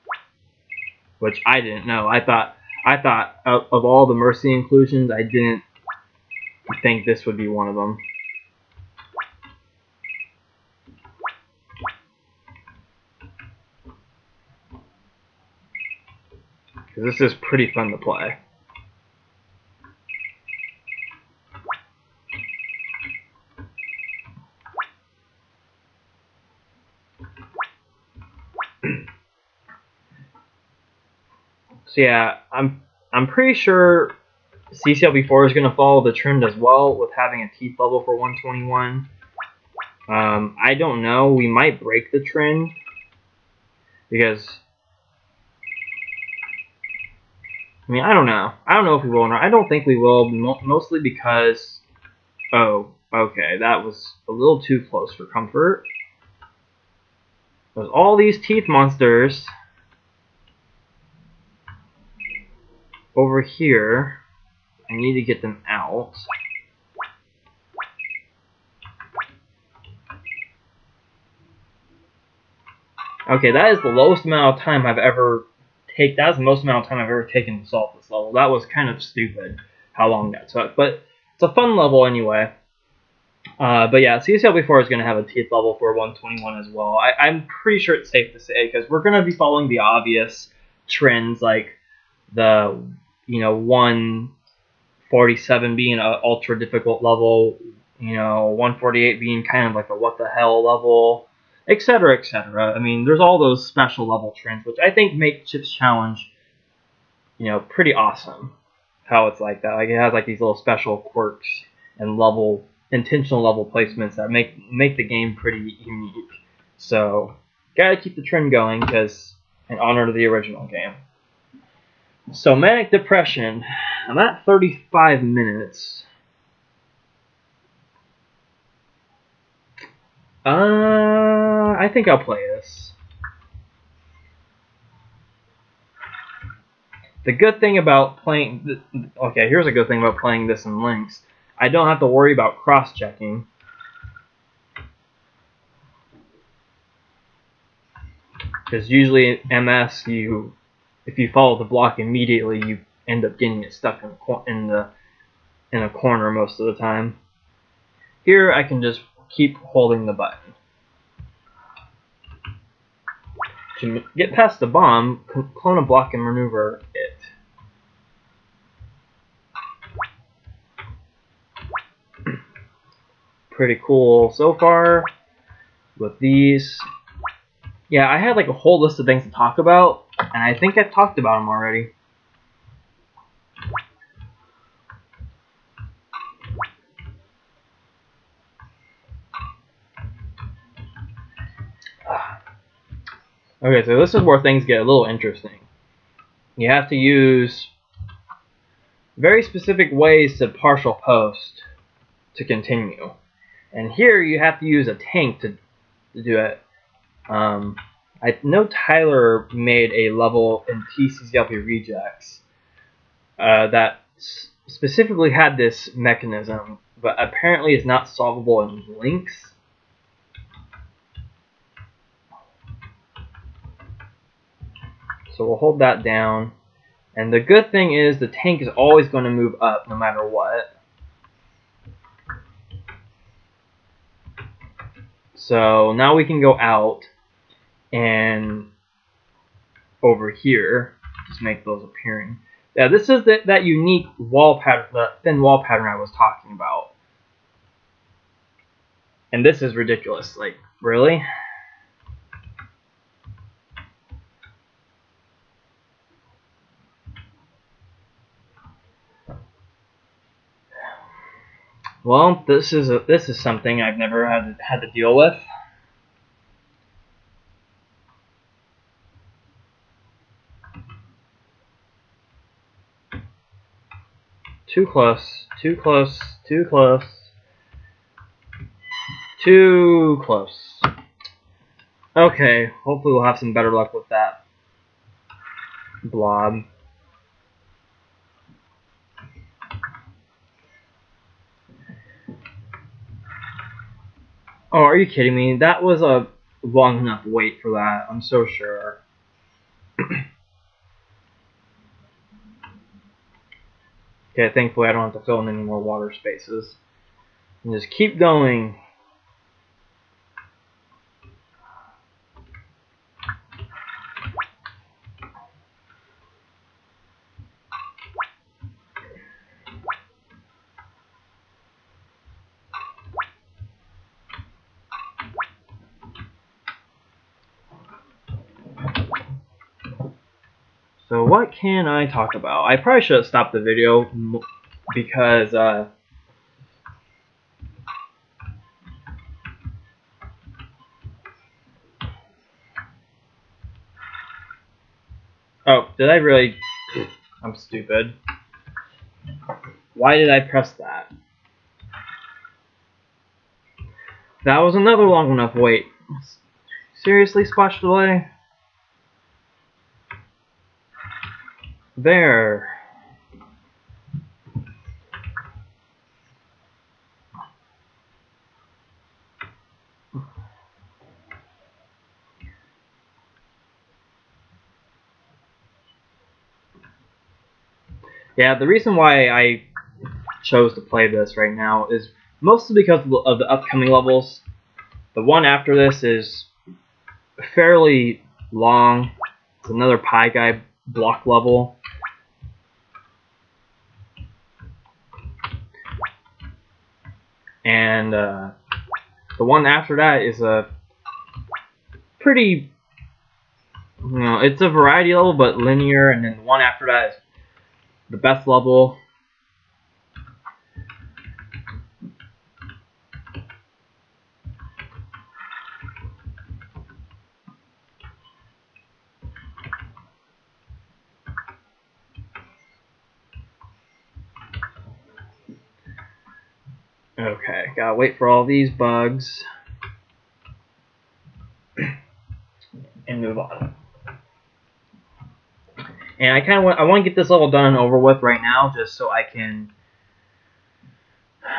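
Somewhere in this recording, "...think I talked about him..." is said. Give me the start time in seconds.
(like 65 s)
180 s.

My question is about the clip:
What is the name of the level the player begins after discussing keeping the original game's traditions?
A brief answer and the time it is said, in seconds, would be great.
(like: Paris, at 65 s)
Manic Depression, at 122 s.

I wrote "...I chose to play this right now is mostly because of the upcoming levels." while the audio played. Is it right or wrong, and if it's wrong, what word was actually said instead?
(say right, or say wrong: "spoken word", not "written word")
right.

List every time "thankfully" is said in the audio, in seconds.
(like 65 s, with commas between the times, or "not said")
304 s.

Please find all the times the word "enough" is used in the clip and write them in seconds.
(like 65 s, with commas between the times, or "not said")
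296 s, 355 s.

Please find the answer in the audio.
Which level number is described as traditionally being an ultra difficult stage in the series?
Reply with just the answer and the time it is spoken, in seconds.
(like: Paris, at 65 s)
147, at 93 s.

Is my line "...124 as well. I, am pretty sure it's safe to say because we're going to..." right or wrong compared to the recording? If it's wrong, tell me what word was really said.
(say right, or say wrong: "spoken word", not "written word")
wrong: "121", not "124".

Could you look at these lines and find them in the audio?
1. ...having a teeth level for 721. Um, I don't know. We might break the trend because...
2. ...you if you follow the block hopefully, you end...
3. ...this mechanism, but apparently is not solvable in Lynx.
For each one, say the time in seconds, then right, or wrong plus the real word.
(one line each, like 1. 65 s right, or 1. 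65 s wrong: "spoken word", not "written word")
1. 37 s wrong: "121", not "721"
2. 150 s wrong: "immediately", not "hopefully"
3. 215 s right.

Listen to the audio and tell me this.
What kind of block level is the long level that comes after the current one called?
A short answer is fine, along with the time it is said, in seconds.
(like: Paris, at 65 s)
Pie Guy block level, at 389 s.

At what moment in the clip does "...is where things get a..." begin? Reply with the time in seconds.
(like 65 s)
194 s.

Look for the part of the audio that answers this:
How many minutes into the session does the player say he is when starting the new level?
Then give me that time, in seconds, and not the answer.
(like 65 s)
124 s.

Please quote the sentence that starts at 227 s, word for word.
And the good thing is the tank is always going to move up no matter what.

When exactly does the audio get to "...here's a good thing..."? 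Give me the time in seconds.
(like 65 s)
139 s.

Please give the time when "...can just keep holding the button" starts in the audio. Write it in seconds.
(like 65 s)
158 s.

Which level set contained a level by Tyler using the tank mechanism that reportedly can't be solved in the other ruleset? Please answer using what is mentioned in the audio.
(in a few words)
TCCLP Rejects.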